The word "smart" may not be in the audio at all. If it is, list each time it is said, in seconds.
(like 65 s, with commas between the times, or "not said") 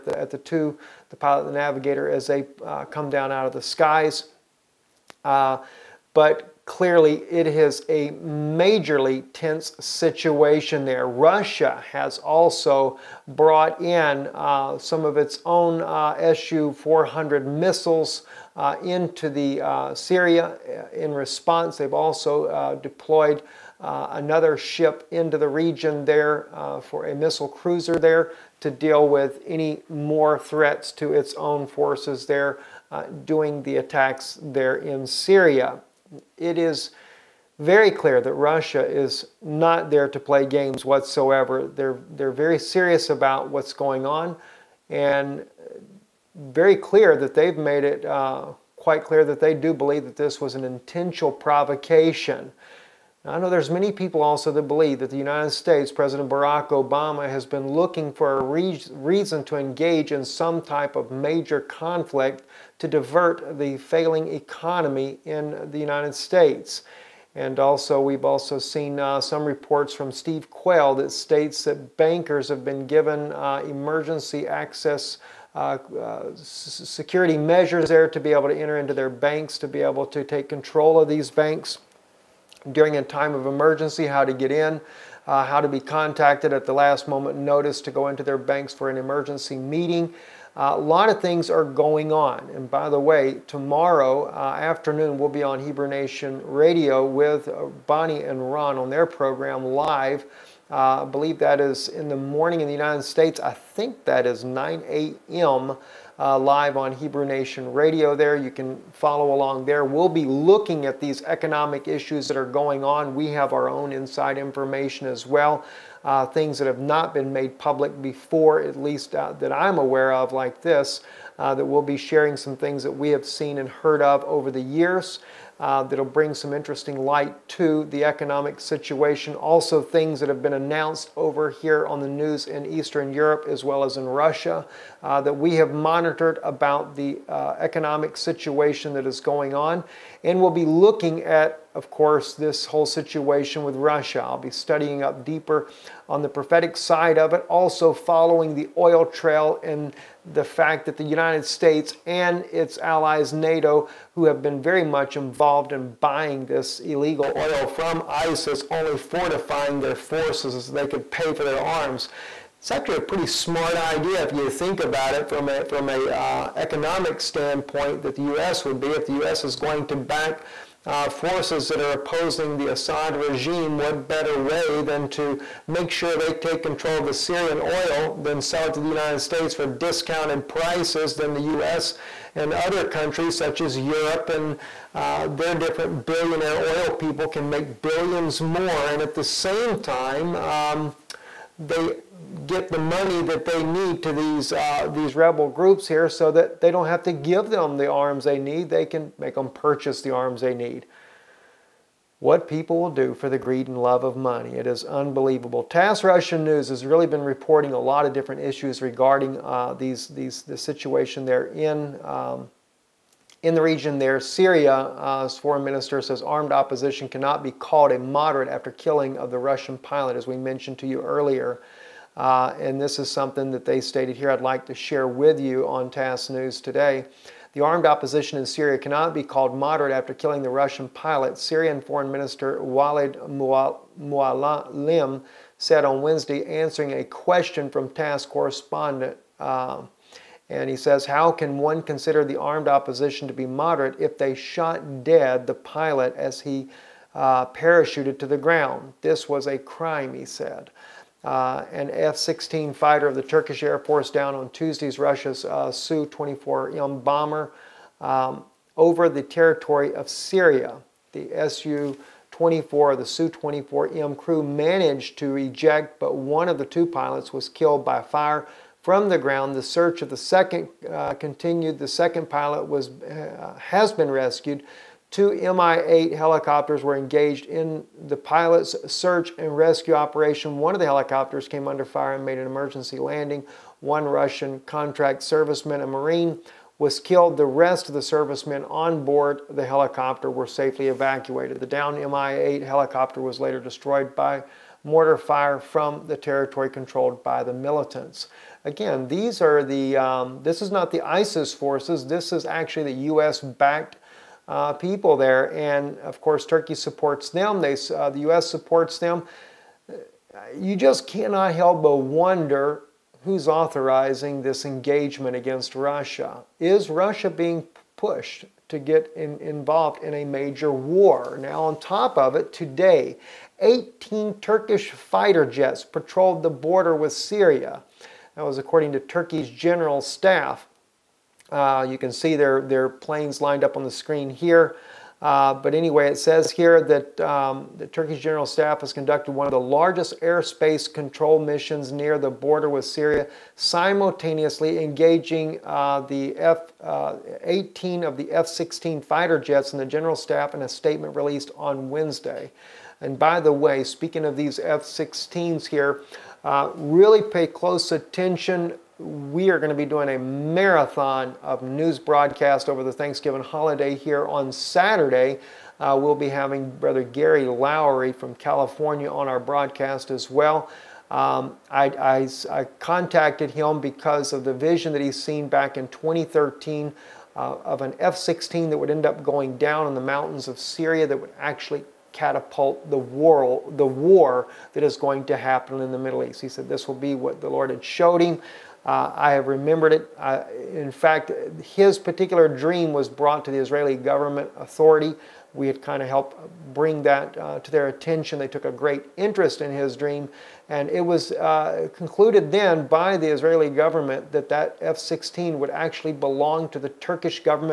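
163 s.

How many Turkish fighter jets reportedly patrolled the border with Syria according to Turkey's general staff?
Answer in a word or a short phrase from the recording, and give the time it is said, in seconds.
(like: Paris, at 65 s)
18, at 323 s.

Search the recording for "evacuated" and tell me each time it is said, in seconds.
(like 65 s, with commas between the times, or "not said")
290 s.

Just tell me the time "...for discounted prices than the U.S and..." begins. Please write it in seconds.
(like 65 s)
179 s.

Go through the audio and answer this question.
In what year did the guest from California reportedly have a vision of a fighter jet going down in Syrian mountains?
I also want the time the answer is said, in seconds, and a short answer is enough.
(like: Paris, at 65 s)
2013, at 375 s.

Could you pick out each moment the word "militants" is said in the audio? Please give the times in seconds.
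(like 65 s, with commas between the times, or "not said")
297 s.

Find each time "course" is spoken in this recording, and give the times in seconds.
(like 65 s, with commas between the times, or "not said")
141 s, 306 s.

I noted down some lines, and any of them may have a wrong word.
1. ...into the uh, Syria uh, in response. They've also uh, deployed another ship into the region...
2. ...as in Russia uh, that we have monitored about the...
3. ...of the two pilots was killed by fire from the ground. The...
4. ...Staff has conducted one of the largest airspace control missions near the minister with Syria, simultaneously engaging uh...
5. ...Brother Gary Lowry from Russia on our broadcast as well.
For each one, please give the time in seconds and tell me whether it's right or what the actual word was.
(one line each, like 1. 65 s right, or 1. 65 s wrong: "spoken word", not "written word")
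1. 18 s right
2. 133 s right
3. 266 s right
4. 338 s wrong: "border", not "minister"
5. 366 s wrong: "California", not "Russia".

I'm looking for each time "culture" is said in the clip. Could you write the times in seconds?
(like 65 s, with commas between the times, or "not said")
not said.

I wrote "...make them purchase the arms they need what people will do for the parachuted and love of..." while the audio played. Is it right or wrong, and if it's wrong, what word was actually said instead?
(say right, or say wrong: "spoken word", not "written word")
wrong: "greed", not "parachuted".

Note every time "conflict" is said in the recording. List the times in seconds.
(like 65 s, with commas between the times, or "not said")
61 s.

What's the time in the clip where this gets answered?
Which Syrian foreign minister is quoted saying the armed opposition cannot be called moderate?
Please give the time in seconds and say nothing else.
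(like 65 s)
232 s.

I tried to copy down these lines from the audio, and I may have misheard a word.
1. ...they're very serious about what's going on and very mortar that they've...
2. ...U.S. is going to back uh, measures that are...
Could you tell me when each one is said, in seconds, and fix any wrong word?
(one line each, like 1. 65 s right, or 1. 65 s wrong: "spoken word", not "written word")
1. 42 s wrong: "clear", not "mortar"
2. 169 s wrong: "forces", not "measures".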